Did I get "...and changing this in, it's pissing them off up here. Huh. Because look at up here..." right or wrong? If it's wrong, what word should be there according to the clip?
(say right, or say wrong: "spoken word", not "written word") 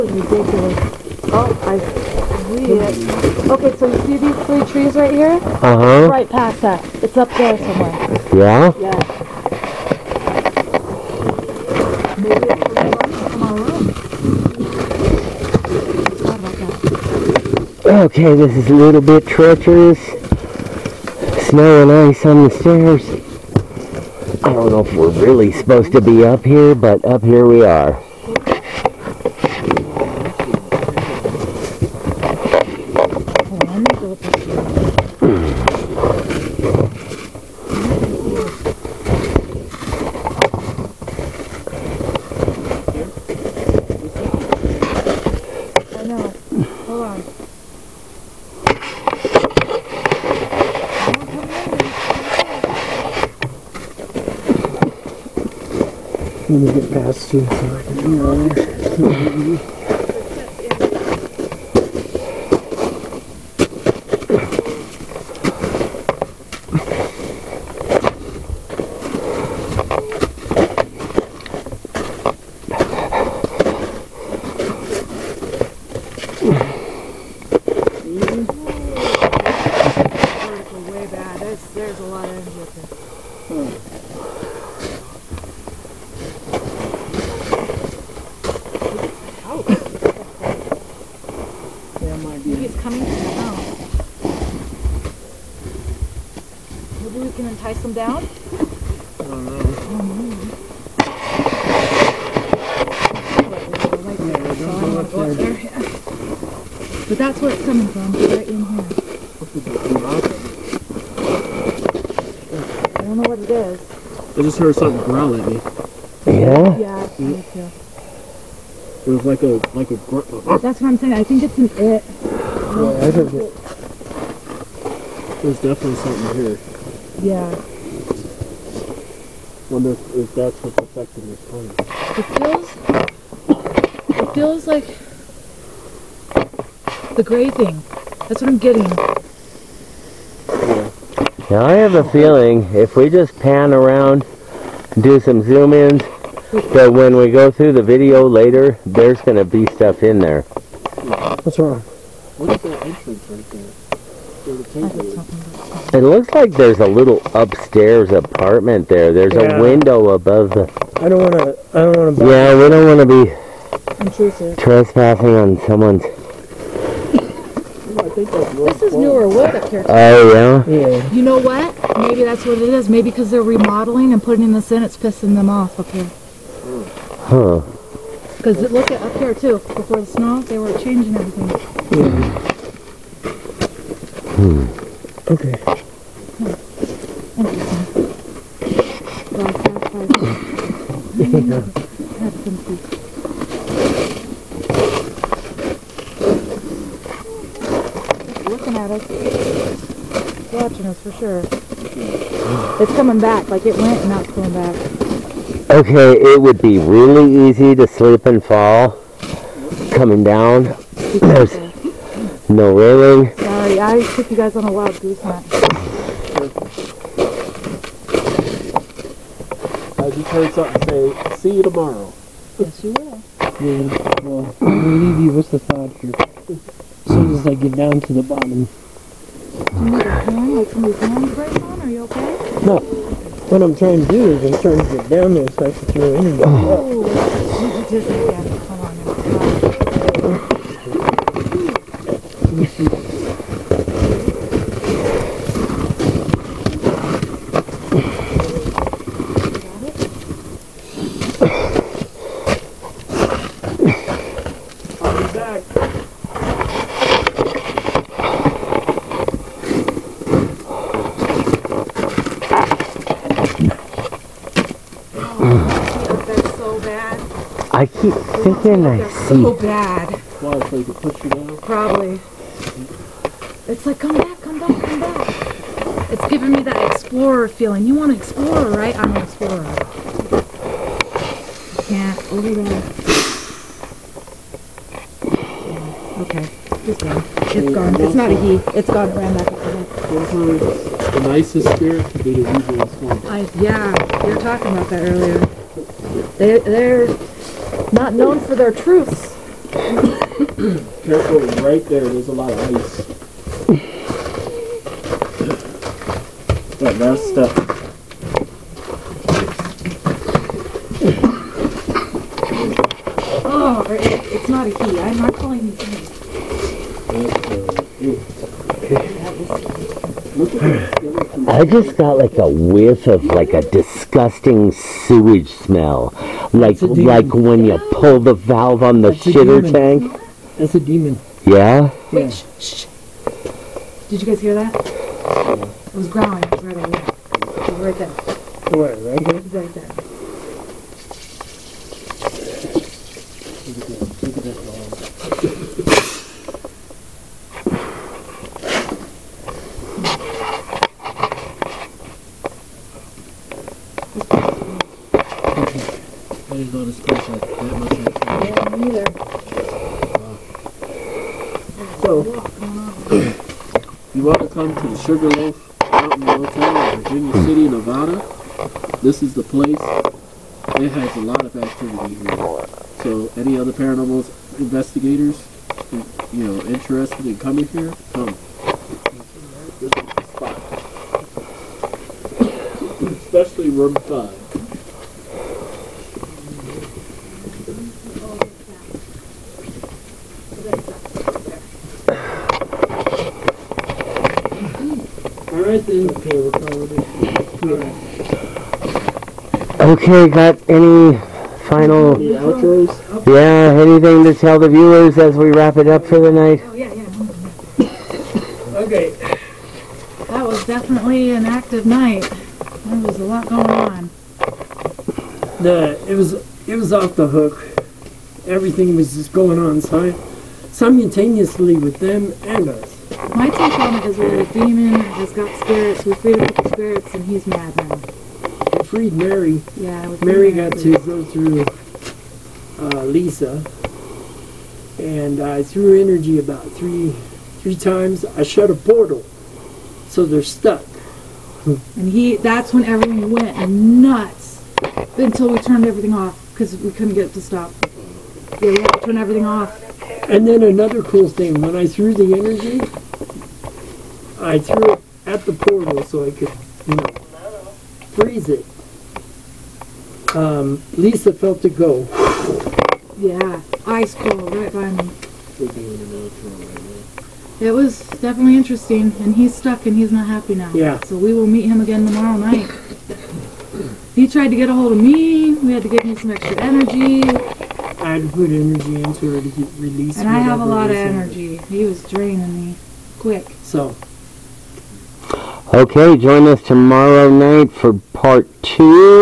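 wrong: "putting", not "changing".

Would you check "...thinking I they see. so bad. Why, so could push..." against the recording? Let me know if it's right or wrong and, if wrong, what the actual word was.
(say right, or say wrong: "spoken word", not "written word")
right.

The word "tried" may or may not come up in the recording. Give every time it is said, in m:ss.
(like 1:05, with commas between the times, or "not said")
7:54.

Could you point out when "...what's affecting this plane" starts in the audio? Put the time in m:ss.
2:10.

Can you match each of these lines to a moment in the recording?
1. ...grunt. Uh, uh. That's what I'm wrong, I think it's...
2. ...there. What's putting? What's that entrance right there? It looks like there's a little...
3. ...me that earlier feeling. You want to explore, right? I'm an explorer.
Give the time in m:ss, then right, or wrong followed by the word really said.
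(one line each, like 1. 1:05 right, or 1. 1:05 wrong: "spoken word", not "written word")
1. 2:00 wrong: "saying", not "wrong"
2. 2:30 wrong: "wrong", not "putting"
3. 4:36 wrong: "explorer", not "earlier".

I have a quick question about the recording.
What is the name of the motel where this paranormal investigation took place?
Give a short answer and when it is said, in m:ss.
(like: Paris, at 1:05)
Sugarloaf Mountain Motel, at 6:04.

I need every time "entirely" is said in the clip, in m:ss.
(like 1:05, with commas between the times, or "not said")
not said.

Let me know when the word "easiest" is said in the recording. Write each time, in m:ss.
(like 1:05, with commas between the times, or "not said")
4:52.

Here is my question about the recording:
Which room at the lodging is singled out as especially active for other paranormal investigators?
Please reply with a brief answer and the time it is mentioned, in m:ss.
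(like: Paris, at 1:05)
Room 5, at 6:23.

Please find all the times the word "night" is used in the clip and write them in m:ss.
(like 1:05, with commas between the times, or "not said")
6:46, 6:51, 7:52, 8:07.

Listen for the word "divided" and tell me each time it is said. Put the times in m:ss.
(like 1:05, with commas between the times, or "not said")
not said.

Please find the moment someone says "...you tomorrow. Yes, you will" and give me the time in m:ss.
3:41.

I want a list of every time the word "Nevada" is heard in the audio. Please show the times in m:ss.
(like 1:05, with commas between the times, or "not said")
6:07.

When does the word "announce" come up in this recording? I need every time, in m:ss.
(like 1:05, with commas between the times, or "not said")
not said.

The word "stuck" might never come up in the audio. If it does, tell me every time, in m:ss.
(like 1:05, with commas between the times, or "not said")
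7:20, 7:49.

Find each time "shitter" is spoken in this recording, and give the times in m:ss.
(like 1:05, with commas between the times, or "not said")
5:29.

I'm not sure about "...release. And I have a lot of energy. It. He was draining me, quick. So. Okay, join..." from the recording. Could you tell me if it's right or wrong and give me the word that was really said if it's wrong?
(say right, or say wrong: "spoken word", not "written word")
right.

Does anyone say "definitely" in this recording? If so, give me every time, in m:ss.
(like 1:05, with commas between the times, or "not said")
2:05, 6:50, 7:48.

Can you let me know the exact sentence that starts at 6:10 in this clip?
It has a lot of activity here.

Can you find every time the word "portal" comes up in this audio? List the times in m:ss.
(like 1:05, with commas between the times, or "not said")
7:18, 7:35.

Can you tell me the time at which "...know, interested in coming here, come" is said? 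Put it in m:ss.
6:16.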